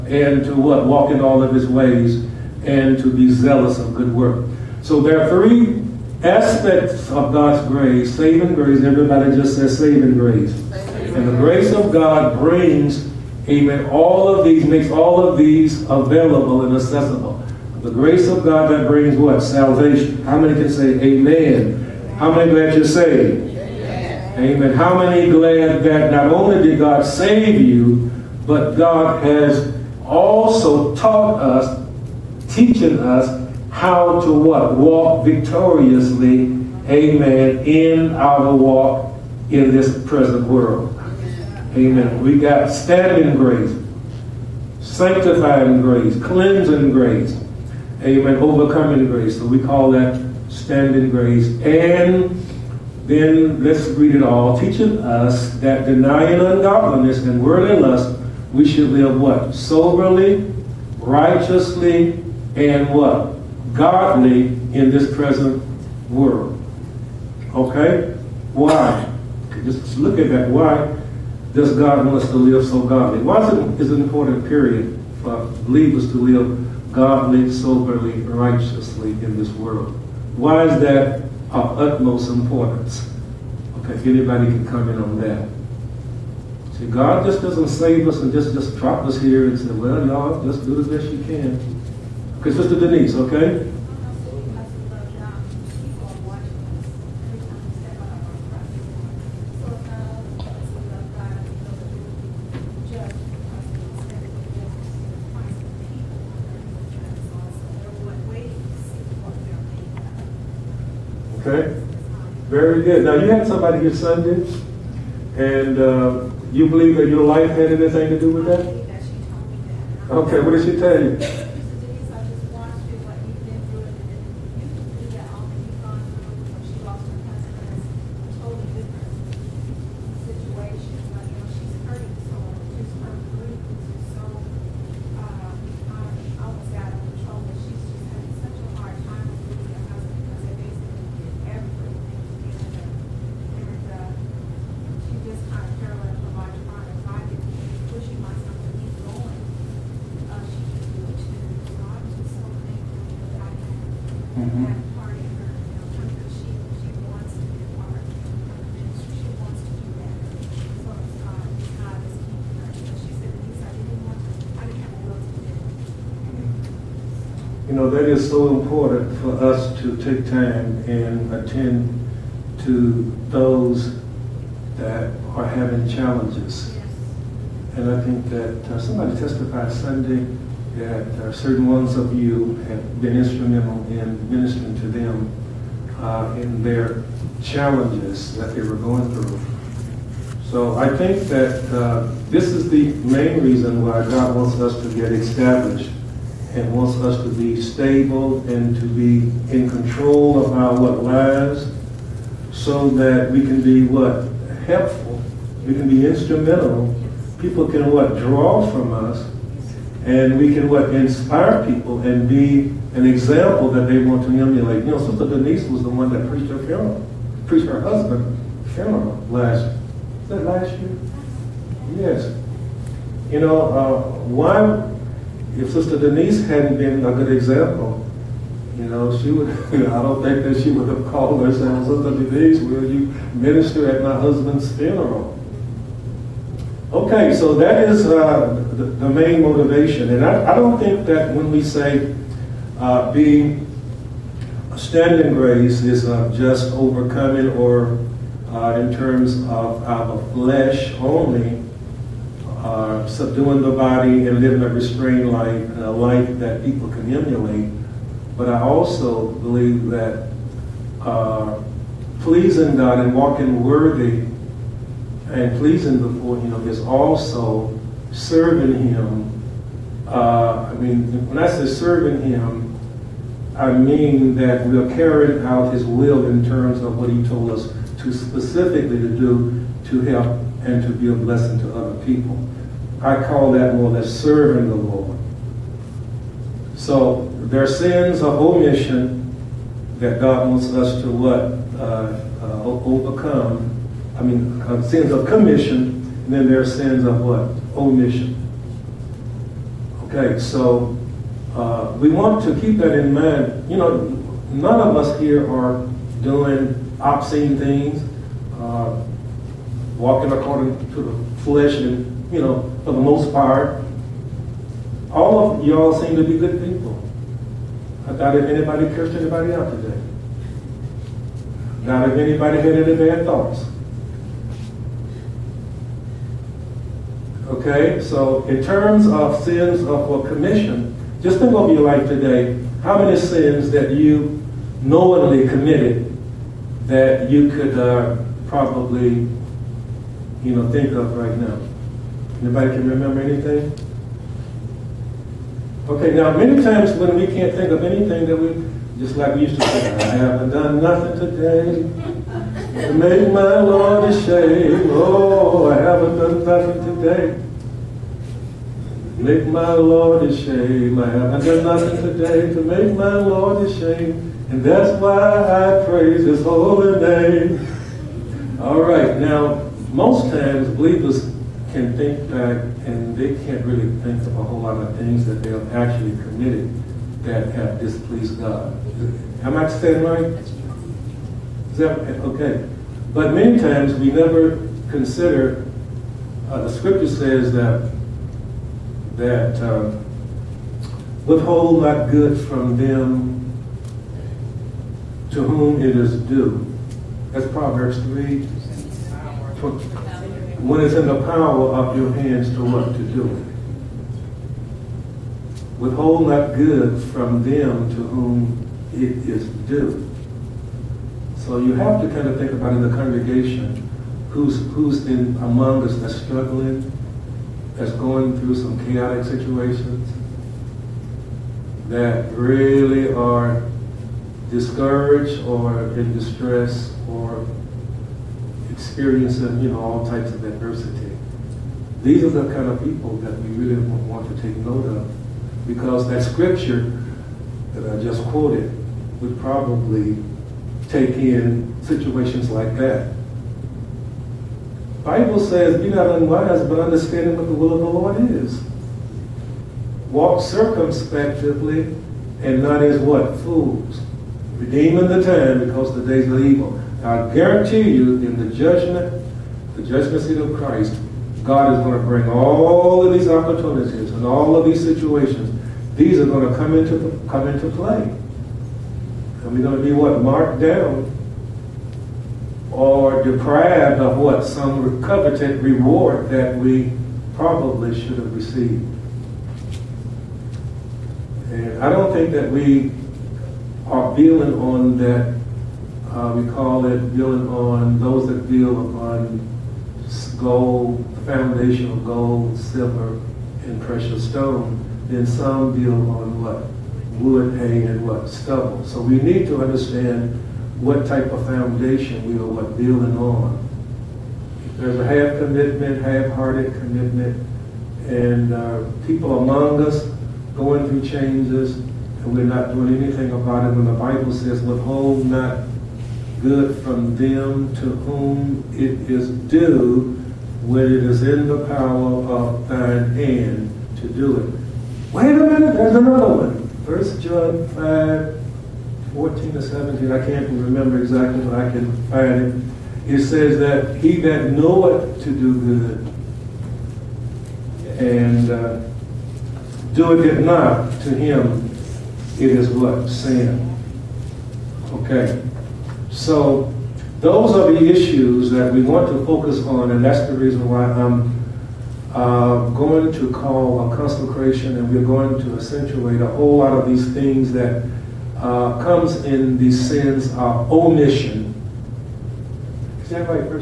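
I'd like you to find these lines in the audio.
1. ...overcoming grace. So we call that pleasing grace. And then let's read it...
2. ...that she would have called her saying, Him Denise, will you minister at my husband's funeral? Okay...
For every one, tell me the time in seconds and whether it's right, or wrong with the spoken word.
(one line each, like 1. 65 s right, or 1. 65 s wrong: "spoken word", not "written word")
1. 48 s wrong: "standing", not "pleasing"
2. 230 s wrong: "Sister", not "Him".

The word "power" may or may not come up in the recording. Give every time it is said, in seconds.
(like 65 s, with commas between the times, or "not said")
401 s, 521 s.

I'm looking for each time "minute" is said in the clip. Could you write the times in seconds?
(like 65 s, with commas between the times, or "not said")
525 s.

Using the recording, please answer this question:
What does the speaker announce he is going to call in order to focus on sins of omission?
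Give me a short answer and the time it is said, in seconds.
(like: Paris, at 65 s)
A consecration, at 553 s.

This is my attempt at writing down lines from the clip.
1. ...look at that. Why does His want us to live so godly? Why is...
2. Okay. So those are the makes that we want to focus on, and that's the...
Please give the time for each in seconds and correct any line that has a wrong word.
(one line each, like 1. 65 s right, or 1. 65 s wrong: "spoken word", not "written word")
1. 69 s wrong: "God", not "His"
2. 544 s wrong: "issues", not "makes".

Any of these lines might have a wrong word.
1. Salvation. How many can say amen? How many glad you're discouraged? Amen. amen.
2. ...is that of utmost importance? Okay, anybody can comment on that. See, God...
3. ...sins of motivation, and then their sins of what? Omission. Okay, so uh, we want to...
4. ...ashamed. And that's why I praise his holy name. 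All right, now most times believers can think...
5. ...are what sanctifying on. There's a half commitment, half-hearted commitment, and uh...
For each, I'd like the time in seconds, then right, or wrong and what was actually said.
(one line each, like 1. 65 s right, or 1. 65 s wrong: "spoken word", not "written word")
1. 19 s wrong: "saved", not "discouraged"
2. 80 s right
3. 294 s wrong: "commission", not "motivation"
4. 363 s right
5. 502 s wrong: "building", not "sanctifying".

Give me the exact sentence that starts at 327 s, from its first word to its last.
Okay, so in terms of sins of a commission, just think over your life today.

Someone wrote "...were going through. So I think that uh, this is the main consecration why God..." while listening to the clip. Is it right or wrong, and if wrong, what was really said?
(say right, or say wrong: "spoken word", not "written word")
wrong: "reason", not "consecration".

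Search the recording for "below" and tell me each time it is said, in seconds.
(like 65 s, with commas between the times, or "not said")
not said.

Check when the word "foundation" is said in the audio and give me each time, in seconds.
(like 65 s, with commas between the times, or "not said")
491 s, 501 s.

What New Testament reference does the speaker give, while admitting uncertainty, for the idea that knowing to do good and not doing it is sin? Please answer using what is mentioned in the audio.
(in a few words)
1 John 5:14-17.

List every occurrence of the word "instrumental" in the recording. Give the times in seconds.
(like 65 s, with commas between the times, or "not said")
183 s, 206 s.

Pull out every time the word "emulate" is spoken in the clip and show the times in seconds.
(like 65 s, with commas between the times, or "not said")
214 s, 257 s.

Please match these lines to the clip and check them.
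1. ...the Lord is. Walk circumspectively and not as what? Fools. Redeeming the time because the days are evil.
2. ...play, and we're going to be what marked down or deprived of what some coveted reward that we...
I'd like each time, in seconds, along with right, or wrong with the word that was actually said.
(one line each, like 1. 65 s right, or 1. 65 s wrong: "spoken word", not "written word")
1. 447 s right
2. 467 s right.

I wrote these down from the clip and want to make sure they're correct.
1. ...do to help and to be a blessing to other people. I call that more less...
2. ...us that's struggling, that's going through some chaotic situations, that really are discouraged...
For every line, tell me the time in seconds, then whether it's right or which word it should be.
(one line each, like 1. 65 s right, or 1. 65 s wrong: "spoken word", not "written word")
1. 279 s right
2. 415 s right.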